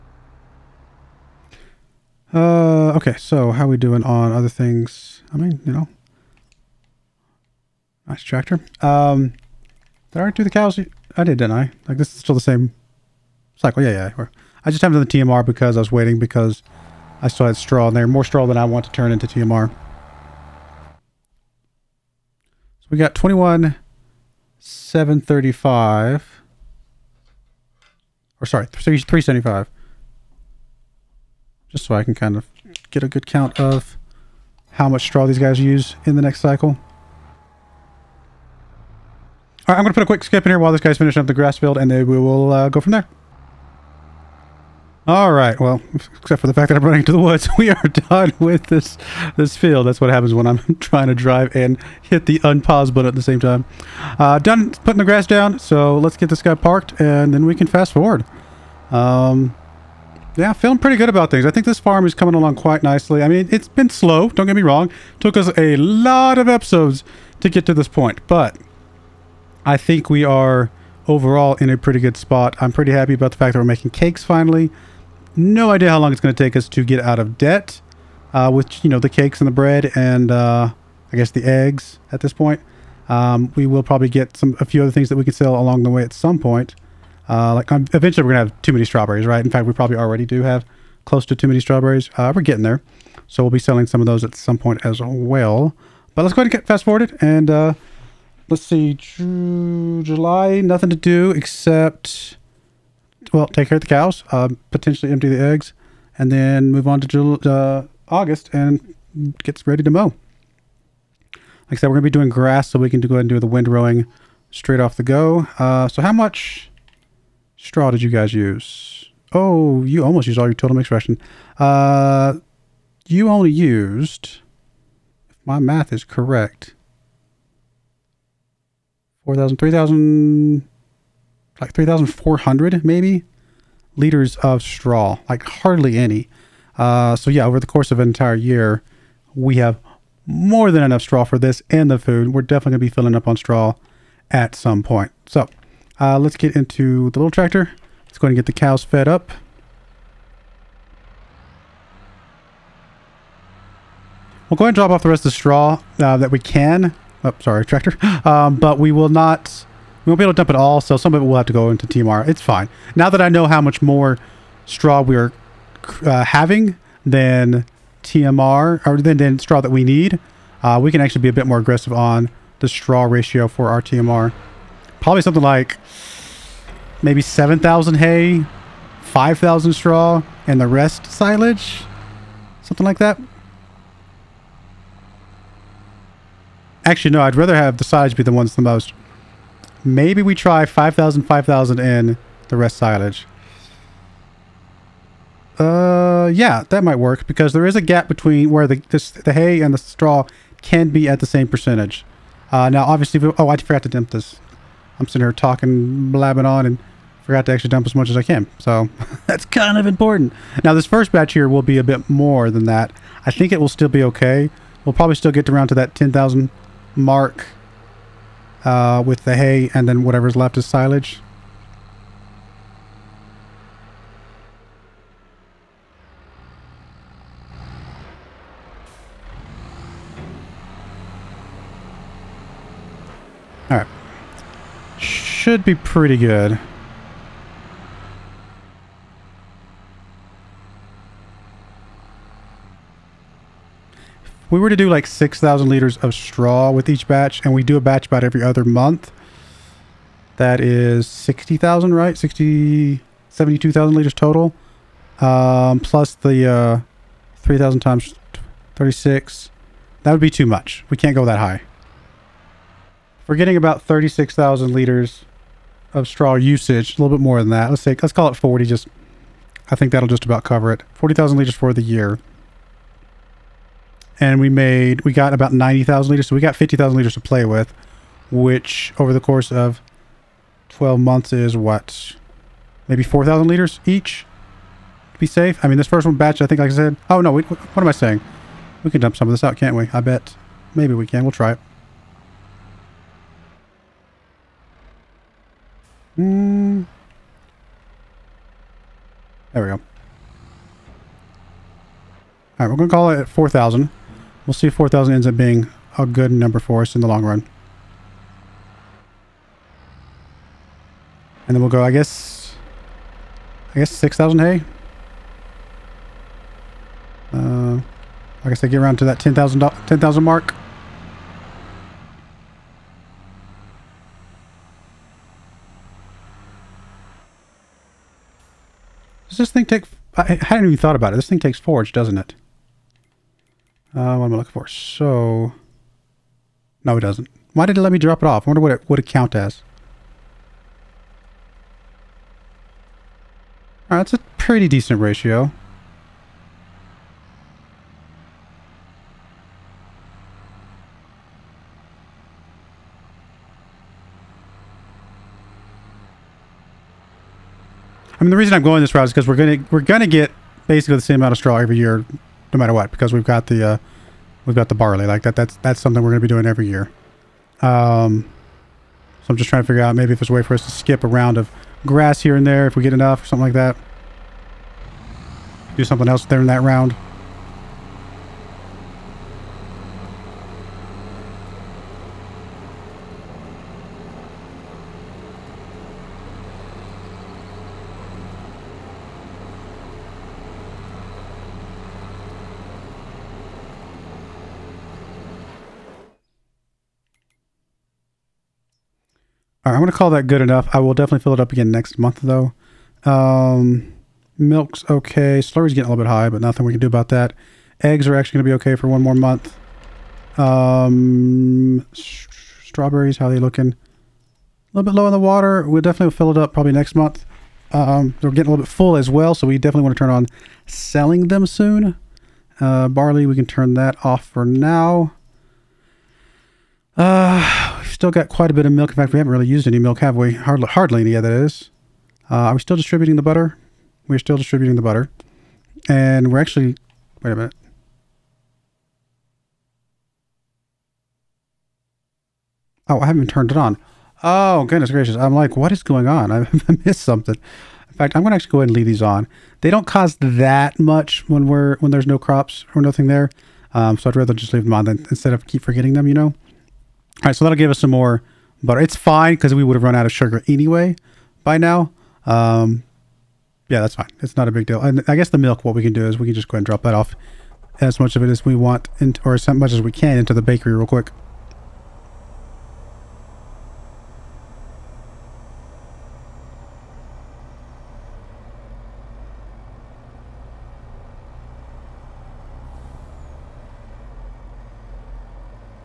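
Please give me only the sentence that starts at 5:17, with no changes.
Uh, guess I get around to that 10,000 10,000 mark.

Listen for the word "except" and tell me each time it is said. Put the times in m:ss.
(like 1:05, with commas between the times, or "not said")
0:46, 1:41.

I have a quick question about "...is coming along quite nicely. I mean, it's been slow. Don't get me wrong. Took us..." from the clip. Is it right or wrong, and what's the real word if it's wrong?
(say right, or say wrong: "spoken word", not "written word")
right.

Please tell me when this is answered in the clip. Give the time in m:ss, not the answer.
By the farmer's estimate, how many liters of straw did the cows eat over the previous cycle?
2:11.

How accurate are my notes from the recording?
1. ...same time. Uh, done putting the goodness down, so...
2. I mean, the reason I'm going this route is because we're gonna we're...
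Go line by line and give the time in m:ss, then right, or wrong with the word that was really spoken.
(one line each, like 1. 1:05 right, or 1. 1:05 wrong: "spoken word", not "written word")
1. 0:53 wrong: "grass", not "goodness"
2. 5:58 right.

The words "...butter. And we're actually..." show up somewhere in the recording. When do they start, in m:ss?
7:14.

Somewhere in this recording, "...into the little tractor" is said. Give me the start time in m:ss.
2:26.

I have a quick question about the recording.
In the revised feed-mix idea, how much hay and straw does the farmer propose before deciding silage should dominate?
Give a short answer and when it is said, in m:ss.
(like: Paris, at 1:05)
5,000 each, at 3:10.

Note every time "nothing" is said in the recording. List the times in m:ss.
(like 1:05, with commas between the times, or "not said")
1:40, 6:46, 7:32.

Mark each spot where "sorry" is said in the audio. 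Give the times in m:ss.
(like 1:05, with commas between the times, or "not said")
0:28, 2:37.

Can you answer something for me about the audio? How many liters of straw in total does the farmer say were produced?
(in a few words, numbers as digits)
90,000 liters.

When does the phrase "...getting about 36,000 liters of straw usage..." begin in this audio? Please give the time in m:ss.
4:23.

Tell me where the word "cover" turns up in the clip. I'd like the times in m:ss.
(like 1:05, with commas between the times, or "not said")
4:30.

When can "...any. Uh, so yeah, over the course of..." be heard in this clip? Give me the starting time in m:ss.
2:15.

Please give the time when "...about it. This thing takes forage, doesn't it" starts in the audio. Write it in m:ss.
5:30.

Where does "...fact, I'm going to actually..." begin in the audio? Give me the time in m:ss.
7:27.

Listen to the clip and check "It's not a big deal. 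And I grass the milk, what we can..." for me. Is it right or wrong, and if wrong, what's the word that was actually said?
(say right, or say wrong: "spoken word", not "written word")
wrong: "guess", not "grass".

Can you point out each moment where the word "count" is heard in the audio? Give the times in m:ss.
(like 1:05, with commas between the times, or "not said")
0:33, 5:39.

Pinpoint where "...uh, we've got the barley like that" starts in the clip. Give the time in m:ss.
6:03.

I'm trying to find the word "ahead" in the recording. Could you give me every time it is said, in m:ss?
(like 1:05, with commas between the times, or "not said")
1:36, 1:53, 2:34, 7:28, 7:46.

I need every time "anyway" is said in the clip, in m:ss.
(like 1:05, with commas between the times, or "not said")
7:40.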